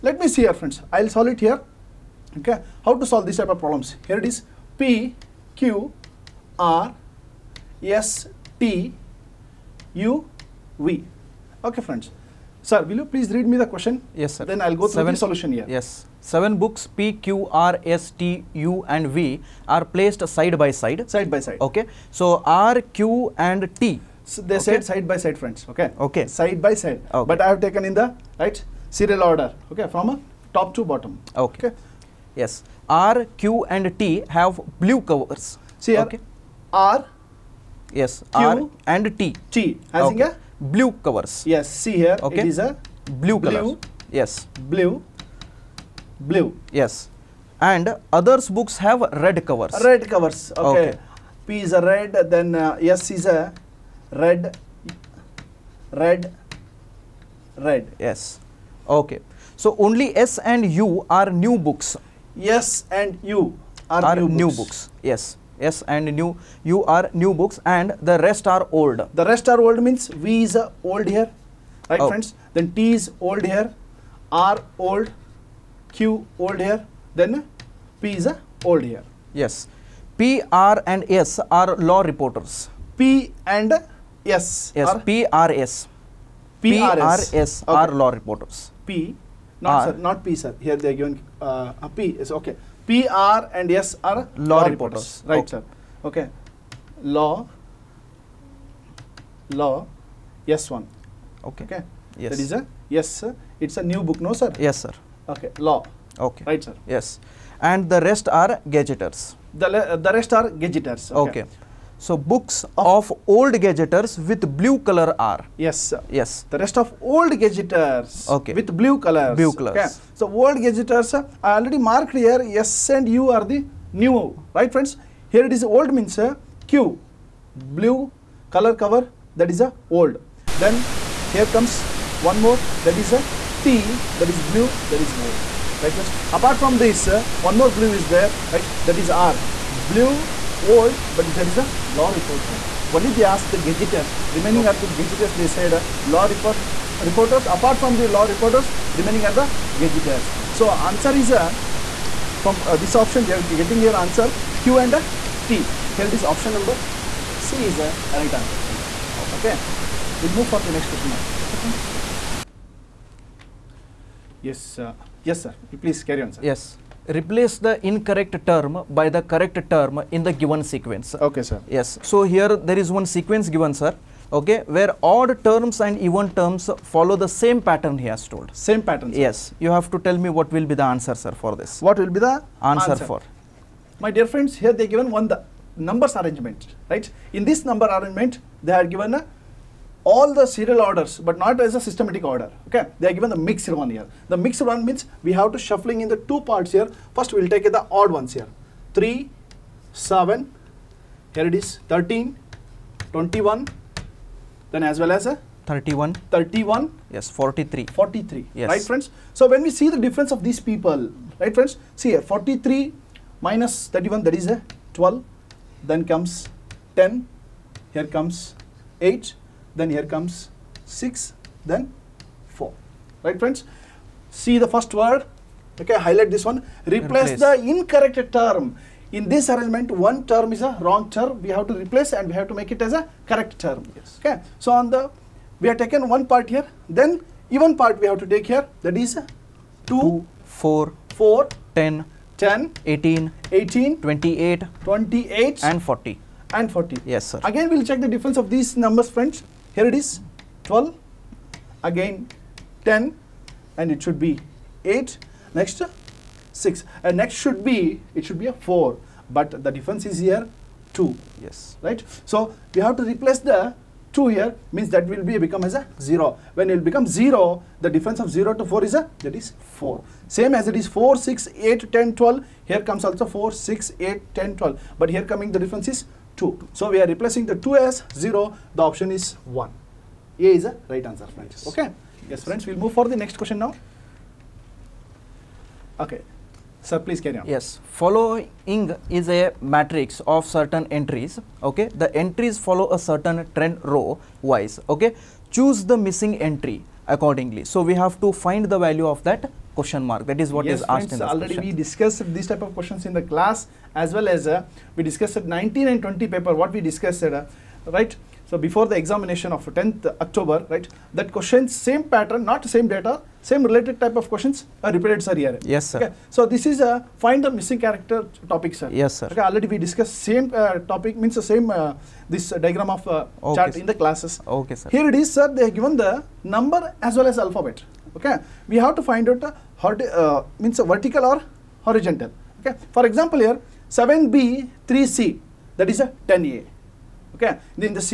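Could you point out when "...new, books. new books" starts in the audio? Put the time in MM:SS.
01:04.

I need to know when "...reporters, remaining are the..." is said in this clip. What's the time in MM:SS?
02:28.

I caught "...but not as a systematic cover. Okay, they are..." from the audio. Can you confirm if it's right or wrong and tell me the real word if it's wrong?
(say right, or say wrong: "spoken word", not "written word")
wrong: "order", not "cover".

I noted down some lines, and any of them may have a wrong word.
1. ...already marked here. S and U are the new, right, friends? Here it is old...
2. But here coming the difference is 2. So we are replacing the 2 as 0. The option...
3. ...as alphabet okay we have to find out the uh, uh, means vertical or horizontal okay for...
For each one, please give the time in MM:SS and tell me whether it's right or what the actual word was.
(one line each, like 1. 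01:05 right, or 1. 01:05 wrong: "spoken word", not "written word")
1. 02:01 right
2. 04:34 right
3. 05:27 right.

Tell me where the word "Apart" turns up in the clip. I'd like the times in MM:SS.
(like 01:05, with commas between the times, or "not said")
02:16, 02:27.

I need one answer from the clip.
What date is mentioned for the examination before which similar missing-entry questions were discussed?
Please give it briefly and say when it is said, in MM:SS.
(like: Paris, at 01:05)
10th October, at 05:09.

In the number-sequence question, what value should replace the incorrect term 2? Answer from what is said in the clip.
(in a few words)
0.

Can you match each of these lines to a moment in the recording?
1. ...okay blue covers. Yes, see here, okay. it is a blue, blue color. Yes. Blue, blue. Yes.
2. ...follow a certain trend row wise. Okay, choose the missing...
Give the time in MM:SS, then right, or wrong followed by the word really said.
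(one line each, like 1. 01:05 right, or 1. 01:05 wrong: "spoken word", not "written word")
1. 00:40 right
2. 04:52 right.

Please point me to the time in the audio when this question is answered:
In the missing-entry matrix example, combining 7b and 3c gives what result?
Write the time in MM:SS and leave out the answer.
05:36.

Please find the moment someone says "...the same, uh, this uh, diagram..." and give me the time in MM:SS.
05:21.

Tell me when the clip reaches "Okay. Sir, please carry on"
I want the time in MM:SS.
04:45.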